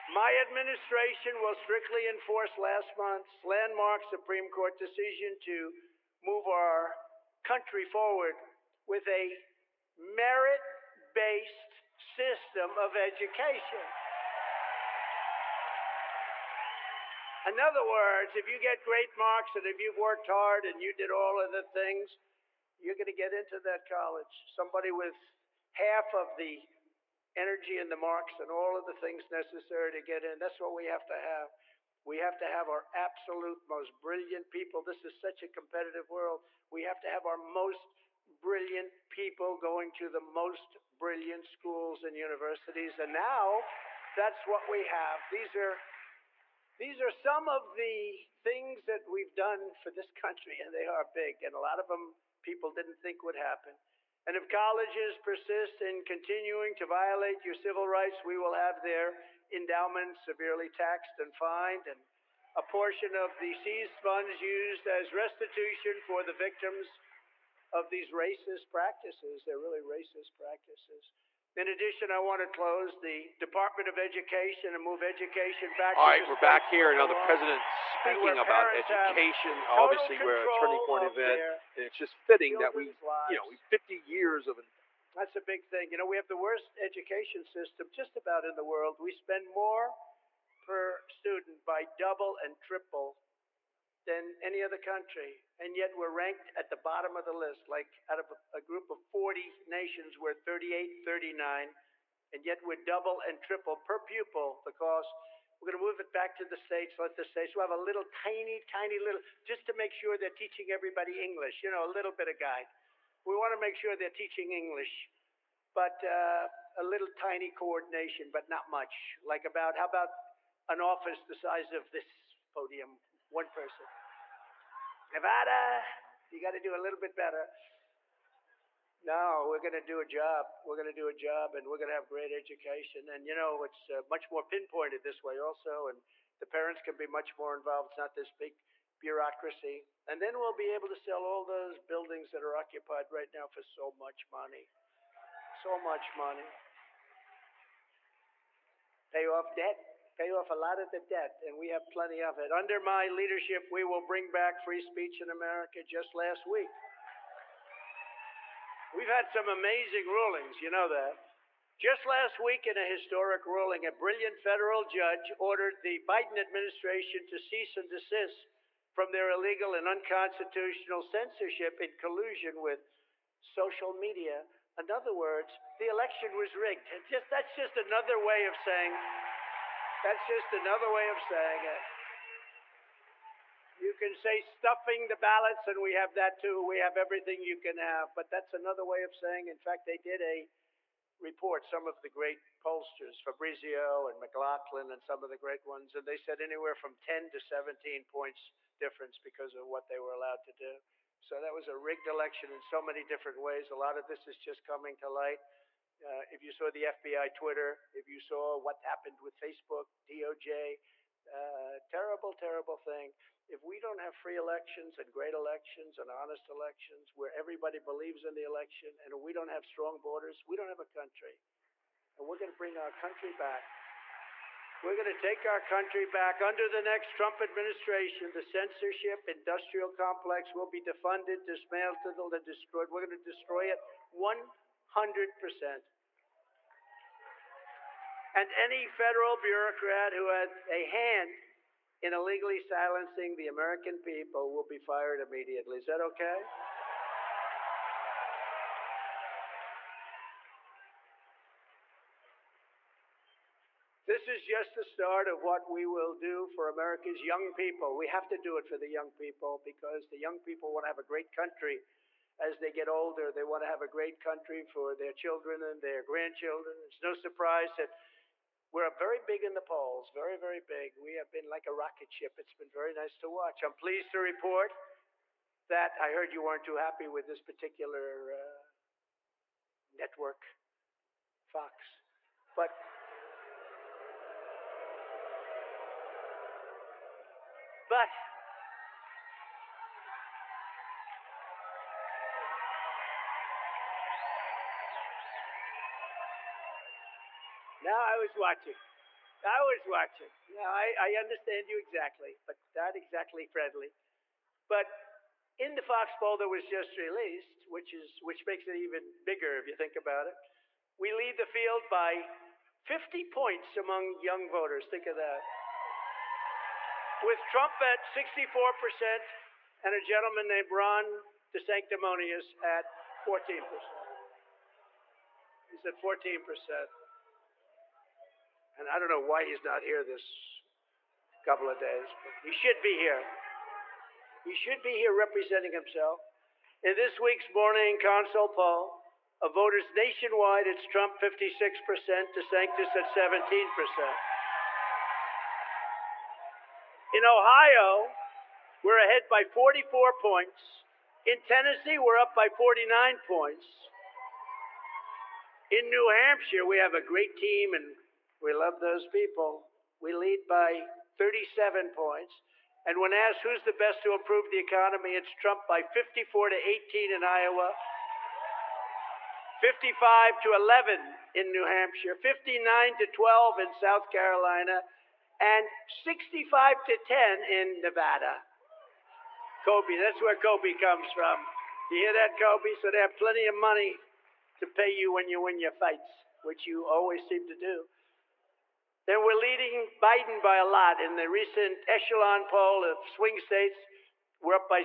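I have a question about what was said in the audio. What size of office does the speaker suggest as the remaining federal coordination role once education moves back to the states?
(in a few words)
the size of this podium.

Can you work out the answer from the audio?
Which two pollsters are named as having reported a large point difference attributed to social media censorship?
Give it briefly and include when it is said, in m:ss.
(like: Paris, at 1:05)
Fabrizio and McLaughlin, at 3:13.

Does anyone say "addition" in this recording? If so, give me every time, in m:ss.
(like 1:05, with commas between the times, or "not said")
1:11.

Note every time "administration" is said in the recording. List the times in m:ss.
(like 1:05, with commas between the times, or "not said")
0:00, 2:46, 3:47.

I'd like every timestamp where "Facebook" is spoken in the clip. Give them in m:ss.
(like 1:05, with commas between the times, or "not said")
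3:29.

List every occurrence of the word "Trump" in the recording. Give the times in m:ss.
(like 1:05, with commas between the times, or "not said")
3:47, 5:17, 5:40, 6:05.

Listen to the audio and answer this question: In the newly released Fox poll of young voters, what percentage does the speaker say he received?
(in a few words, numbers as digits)
64%.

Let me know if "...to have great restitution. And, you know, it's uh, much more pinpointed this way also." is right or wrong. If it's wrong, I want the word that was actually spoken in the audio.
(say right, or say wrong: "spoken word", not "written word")
wrong: "education", not "restitution".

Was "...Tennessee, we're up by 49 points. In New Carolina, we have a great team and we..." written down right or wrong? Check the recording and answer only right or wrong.
wrong.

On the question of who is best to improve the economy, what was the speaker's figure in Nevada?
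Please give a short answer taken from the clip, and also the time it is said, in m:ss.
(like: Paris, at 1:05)
65, at 6:15.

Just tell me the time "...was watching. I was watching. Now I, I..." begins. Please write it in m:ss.
4:58.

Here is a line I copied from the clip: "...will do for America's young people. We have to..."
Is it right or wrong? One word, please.
right.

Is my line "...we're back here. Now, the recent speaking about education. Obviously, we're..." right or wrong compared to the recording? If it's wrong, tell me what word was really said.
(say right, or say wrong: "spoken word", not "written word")
wrong: "president", not "recent".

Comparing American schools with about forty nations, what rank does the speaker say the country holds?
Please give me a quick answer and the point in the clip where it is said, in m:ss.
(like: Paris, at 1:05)
38, 39, at 1:40.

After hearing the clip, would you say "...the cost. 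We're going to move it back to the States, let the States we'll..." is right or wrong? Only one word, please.
right.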